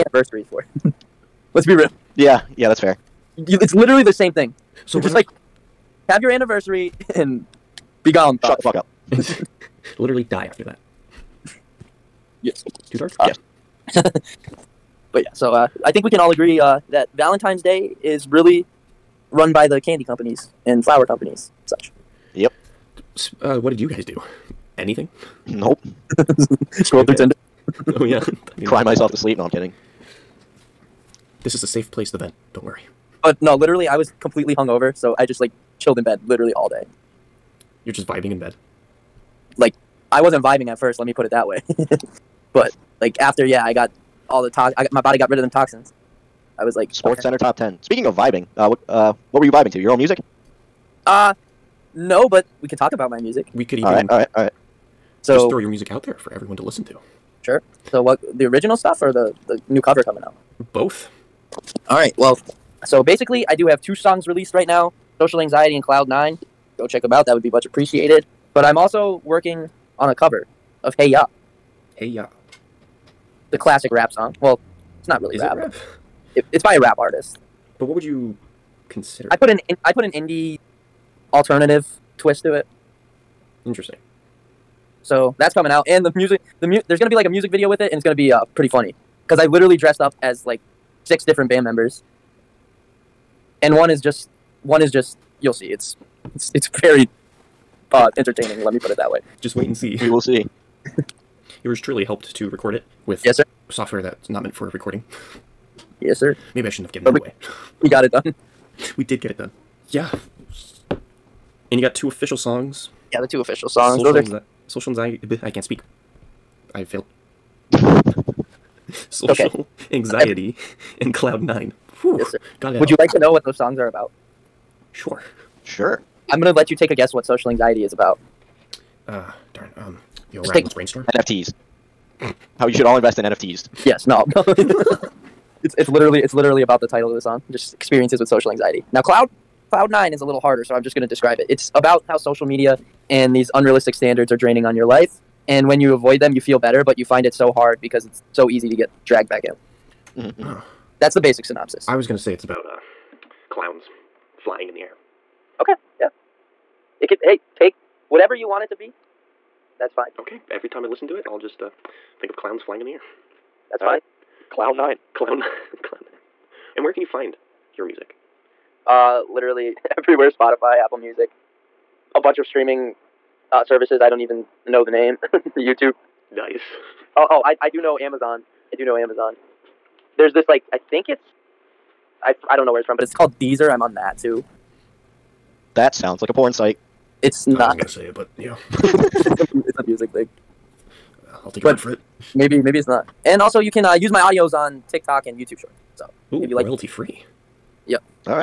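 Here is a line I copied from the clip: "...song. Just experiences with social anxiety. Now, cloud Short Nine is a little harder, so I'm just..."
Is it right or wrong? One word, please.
wrong.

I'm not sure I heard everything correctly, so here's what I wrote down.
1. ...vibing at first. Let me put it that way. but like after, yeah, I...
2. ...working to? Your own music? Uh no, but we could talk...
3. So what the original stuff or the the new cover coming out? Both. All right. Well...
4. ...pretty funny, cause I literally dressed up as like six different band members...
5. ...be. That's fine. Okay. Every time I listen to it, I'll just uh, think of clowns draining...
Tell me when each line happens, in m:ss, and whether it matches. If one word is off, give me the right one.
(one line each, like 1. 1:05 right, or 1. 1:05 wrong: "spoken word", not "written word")
1. 0:40 right
2. 0:49 wrong: "vibing", not "working"
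3. 0:57 right
4. 1:28 right
5. 2:38 wrong: "flying", not "draining".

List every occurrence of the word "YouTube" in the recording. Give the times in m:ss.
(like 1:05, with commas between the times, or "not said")
2:55, 3:15.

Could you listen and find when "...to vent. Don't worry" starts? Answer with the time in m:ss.
0:32.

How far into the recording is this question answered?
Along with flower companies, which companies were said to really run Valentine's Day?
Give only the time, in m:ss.
0:19.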